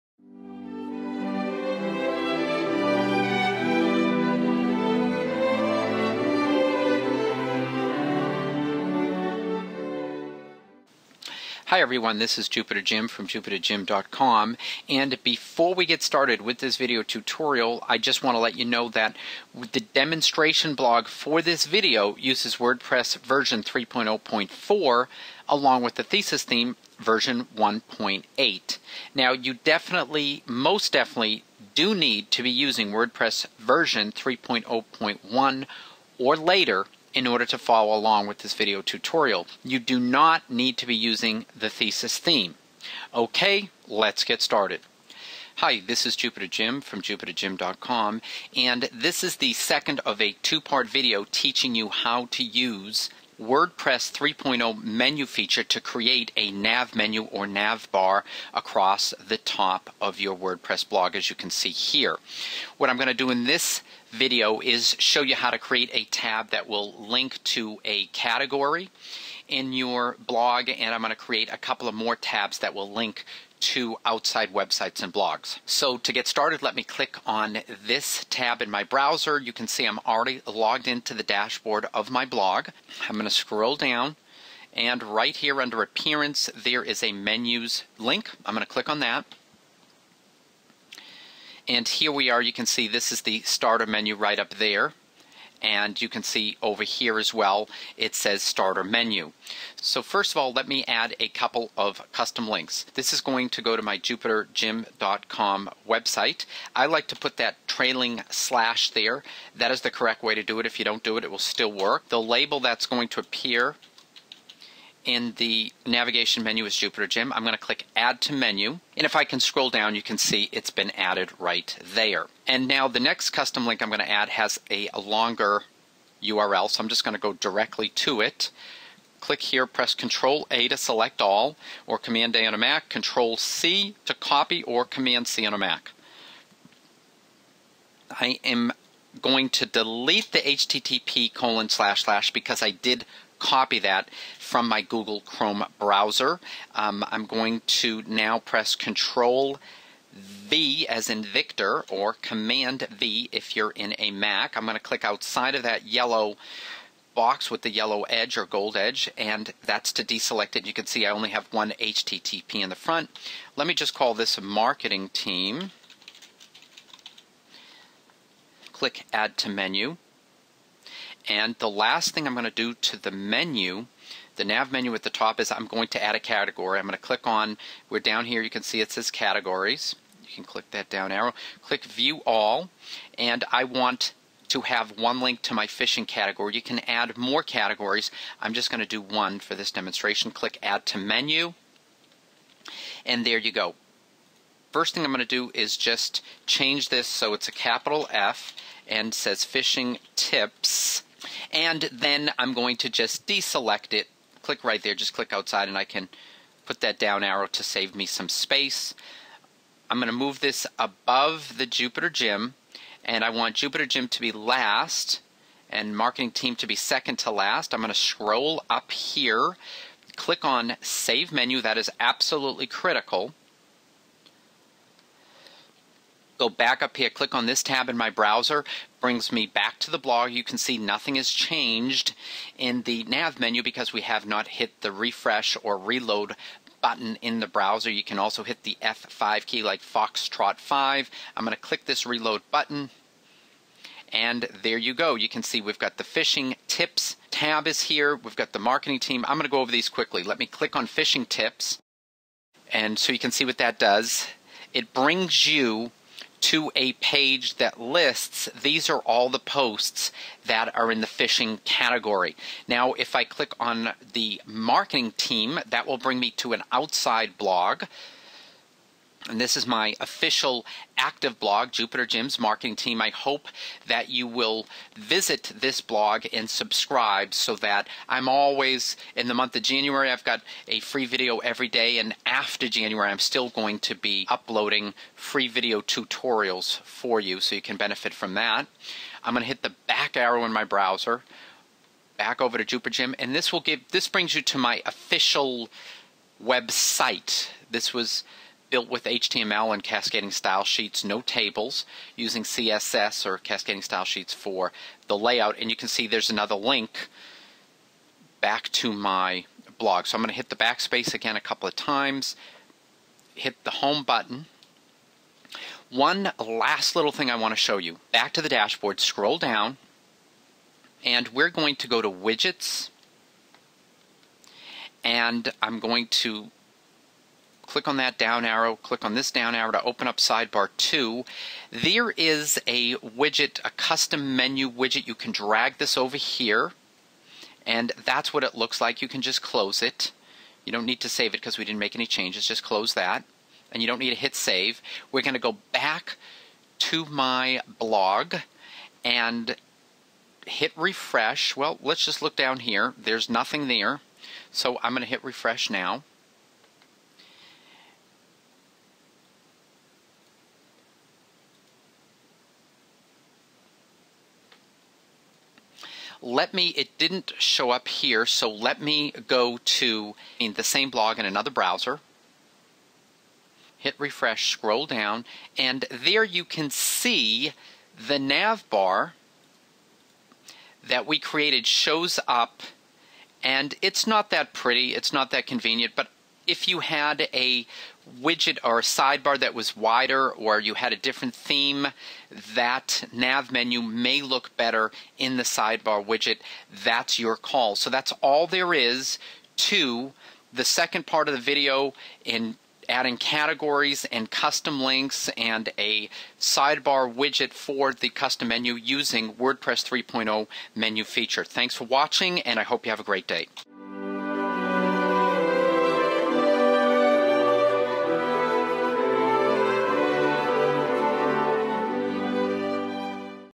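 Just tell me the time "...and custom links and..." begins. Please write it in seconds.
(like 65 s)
404 s.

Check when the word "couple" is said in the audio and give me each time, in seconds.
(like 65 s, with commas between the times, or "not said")
71 s, 101 s, 311 s.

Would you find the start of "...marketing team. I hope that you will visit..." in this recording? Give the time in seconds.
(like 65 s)
272 s.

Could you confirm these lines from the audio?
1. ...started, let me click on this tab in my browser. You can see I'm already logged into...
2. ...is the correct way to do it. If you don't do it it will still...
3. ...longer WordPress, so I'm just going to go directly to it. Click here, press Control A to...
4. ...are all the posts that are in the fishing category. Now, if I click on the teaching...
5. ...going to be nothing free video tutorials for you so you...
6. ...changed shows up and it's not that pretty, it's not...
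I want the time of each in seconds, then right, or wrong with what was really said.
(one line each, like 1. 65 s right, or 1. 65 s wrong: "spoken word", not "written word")
1. 76 s right
2. 109 s right
3. 124 s wrong: "URL", not "WordPress"
4. 258 s wrong: "marketing", not "teaching"
5. 283 s wrong: "uploading", not "nothing"
6. 381 s wrong: "created", not "changed".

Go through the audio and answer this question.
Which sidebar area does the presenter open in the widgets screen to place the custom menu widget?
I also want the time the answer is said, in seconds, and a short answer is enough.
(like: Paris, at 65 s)
Sidebar 2, at 330 s.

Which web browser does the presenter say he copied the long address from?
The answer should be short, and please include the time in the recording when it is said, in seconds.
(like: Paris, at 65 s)
Google Chrome, at 144 s.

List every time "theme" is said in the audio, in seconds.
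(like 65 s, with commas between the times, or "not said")
26 s, 42 s, 391 s.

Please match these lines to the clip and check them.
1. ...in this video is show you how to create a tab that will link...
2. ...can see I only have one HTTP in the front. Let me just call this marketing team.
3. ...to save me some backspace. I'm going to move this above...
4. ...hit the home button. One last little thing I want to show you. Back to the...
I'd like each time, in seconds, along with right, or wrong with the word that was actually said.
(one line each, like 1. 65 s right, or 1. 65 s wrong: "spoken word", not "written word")
1. 63 s right
2. 160 s right
3. 207 s wrong: "space", not "backspace"
4. 313 s right.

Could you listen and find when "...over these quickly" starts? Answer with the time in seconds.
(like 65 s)
249 s.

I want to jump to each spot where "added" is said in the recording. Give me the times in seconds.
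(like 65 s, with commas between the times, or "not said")
120 s.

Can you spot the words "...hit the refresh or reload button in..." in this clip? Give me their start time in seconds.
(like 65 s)
234 s.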